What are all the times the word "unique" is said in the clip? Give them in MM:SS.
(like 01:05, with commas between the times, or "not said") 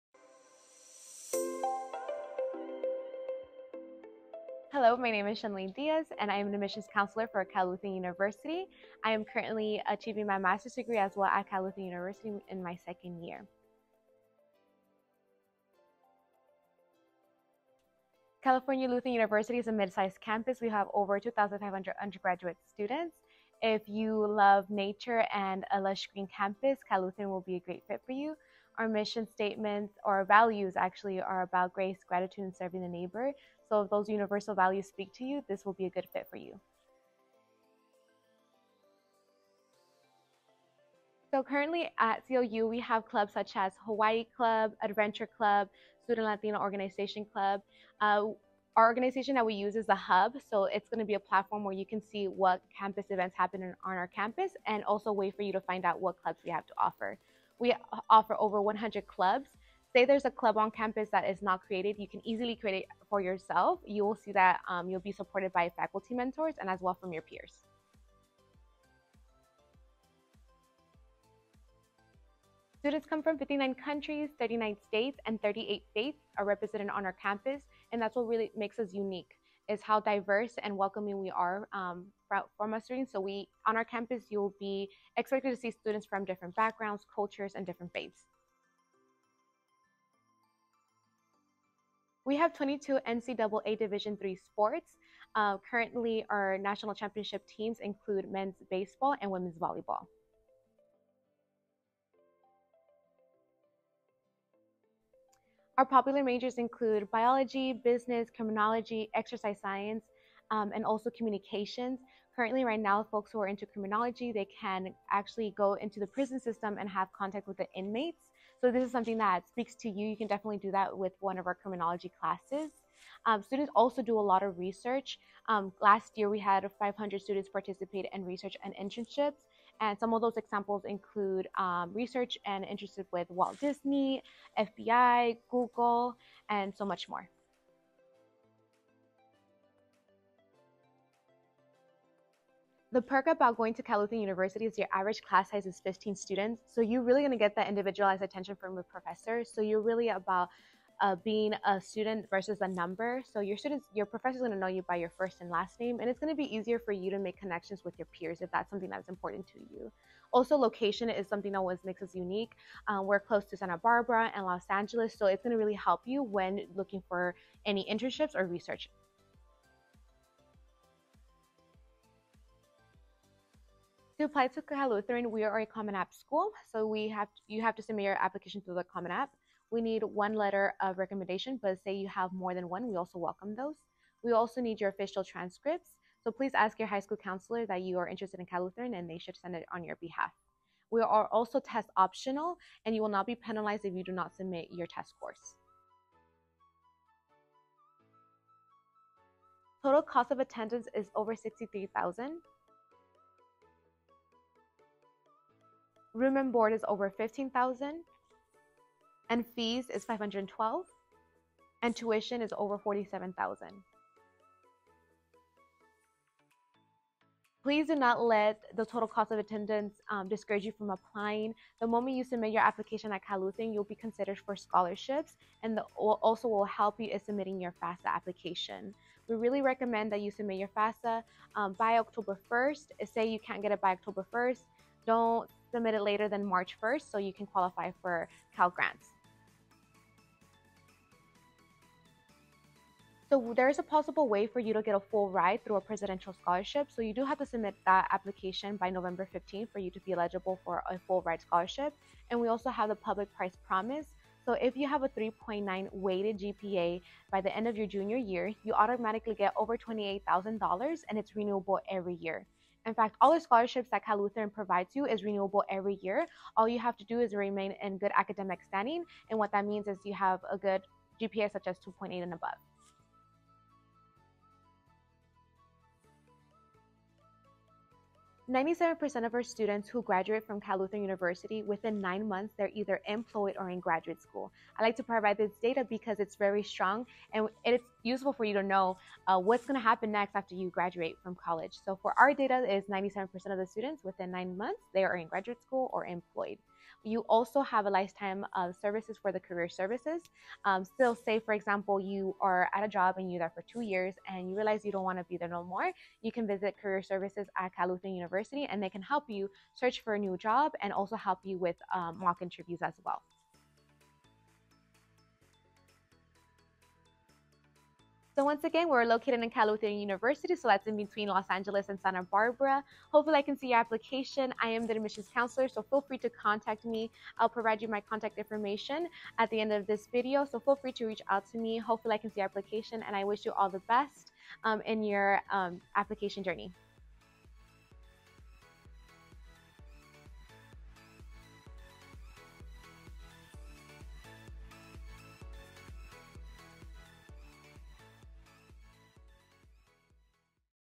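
01:18, 02:42.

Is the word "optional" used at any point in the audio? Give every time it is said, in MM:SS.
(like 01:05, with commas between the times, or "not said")
03:11.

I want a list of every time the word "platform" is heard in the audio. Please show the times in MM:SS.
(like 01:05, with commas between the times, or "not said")
00:51.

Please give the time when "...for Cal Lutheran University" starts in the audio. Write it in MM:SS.
00:07.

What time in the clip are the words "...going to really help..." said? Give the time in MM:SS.
02:45.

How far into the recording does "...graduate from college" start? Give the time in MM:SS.
04:50.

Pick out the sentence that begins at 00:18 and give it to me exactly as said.
California Lutheran University is a mid-sized campus.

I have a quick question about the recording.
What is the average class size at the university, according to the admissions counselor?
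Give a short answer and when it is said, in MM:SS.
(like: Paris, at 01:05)
15 students, at 02:25.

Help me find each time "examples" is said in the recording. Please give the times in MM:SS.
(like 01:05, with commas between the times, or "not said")
02:10, 05:01.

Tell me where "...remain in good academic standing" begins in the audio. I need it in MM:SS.
04:27.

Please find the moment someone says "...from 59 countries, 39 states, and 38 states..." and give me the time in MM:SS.
01:13.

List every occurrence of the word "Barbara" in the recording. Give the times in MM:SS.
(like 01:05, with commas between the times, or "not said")
02:43, 05:22.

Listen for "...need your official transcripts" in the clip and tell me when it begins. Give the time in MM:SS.
03:04.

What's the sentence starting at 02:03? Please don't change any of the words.
Um, students also do a lot of research.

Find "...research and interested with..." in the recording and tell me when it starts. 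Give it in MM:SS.
02:11.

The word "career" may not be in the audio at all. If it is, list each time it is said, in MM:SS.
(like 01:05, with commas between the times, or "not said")
04:59, 05:06.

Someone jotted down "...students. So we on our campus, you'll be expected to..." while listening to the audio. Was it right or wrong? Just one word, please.
right.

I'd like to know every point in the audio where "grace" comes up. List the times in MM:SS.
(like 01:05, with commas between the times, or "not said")
00:31.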